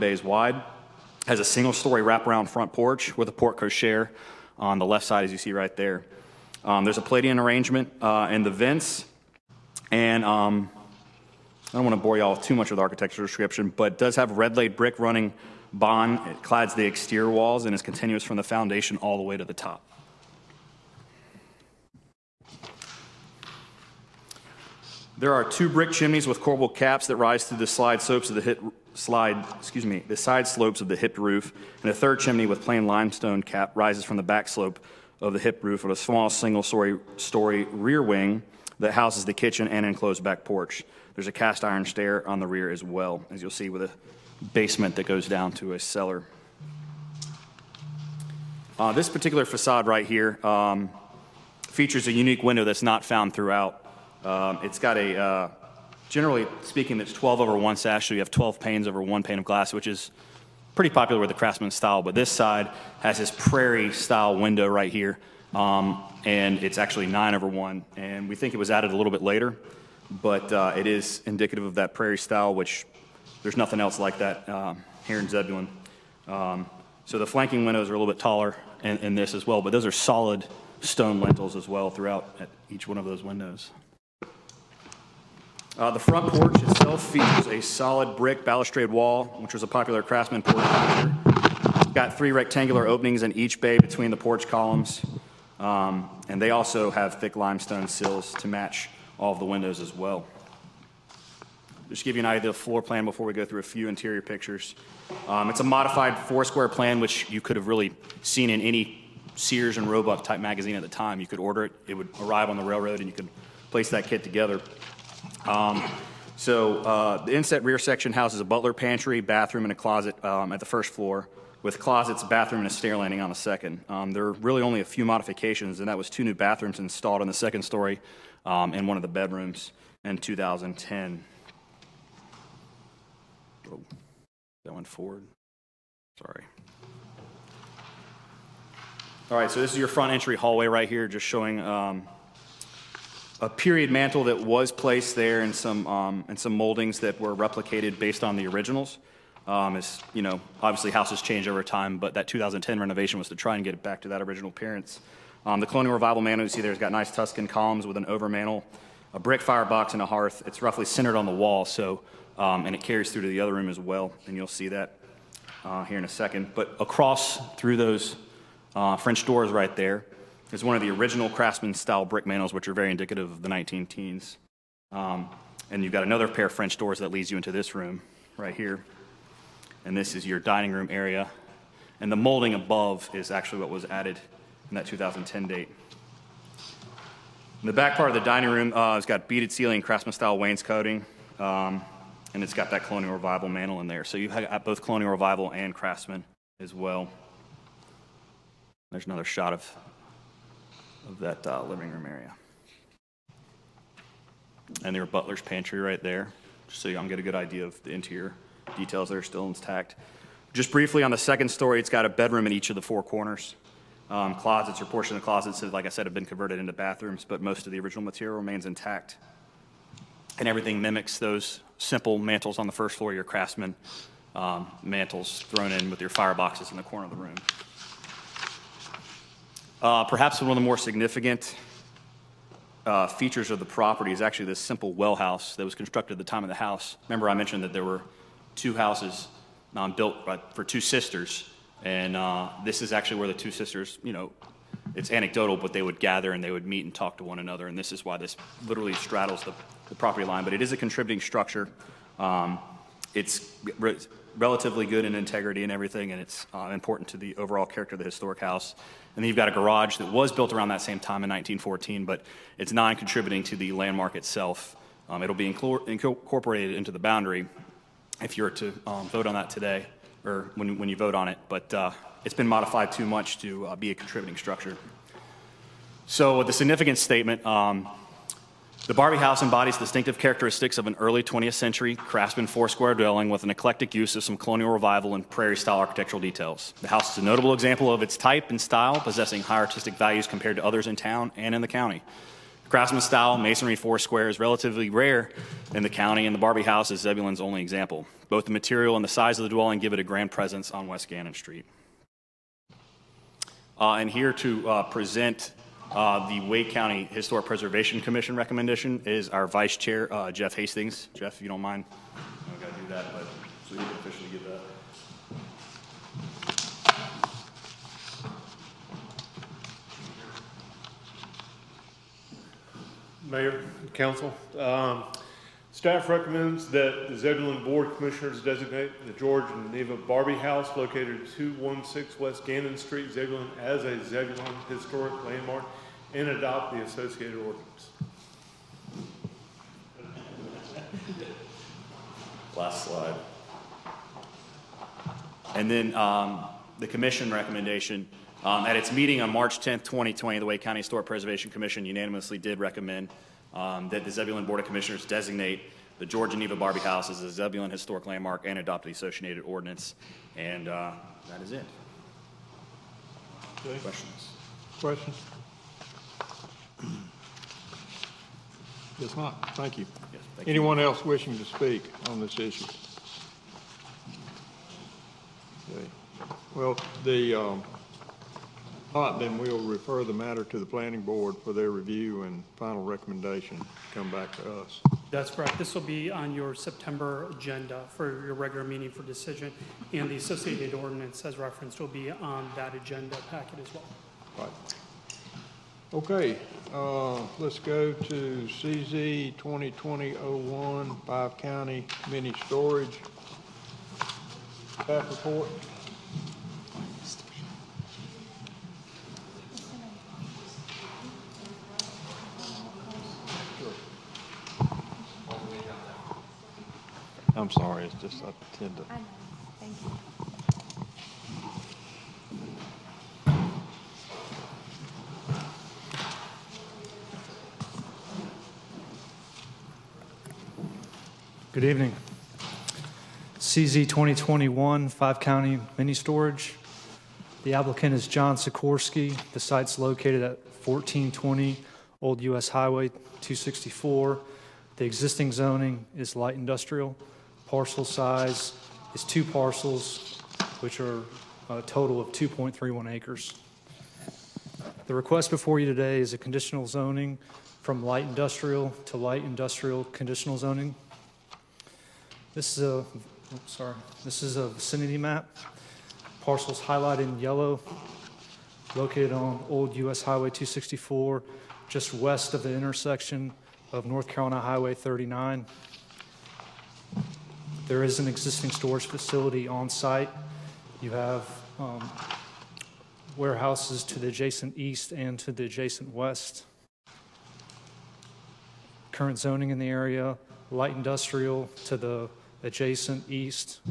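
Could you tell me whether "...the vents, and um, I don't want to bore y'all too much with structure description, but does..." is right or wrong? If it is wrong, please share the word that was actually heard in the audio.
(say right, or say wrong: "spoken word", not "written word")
wrong: "architecture", not "structure".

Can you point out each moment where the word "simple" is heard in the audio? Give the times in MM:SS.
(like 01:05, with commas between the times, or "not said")
03:41, 03:54.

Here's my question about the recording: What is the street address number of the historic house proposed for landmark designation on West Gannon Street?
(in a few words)
216.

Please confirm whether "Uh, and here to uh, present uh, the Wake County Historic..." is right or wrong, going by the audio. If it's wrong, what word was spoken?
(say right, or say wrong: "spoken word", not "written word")
right.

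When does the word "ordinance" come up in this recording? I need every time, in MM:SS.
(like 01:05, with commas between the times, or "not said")
05:37, 05:59, 06:30.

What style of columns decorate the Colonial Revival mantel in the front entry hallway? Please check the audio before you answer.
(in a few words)
Tuscan.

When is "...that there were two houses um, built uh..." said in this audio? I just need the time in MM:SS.
03:57.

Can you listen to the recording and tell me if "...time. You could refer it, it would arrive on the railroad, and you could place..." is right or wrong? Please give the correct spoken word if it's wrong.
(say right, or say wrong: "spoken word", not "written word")
wrong: "order", not "refer".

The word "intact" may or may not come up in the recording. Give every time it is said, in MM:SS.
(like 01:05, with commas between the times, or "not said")
03:29, 03:38.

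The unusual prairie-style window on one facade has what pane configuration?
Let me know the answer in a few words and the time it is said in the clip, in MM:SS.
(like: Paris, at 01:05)
9 over 1, at 01:07.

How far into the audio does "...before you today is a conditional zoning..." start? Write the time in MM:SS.
07:35.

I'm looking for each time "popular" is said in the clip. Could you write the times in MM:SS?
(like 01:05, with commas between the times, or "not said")
01:00, 01:29.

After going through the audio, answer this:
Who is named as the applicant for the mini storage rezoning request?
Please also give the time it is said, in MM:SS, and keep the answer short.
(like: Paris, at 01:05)
John Sikorski, at 07:18.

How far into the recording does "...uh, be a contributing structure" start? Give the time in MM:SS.
04:33.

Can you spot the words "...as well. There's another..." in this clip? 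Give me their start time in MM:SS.
03:16.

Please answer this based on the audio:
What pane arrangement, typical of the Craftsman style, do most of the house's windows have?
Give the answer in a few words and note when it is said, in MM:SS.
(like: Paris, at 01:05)
12 over 1, at 00:57.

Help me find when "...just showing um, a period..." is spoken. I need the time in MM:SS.
02:21.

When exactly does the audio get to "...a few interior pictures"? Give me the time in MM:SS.
01:43.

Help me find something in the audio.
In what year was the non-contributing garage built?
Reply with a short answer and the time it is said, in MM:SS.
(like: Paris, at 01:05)
1914, at 04:21.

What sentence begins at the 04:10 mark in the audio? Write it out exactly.
But it is a contributing structure.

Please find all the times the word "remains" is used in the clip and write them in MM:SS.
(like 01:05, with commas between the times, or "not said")
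03:38.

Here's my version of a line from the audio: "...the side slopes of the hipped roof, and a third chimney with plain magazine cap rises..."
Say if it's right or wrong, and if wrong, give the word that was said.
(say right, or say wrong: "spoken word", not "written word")
wrong: "limestone", not "magazine".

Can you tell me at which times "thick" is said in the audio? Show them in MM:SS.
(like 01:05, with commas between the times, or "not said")
01:37.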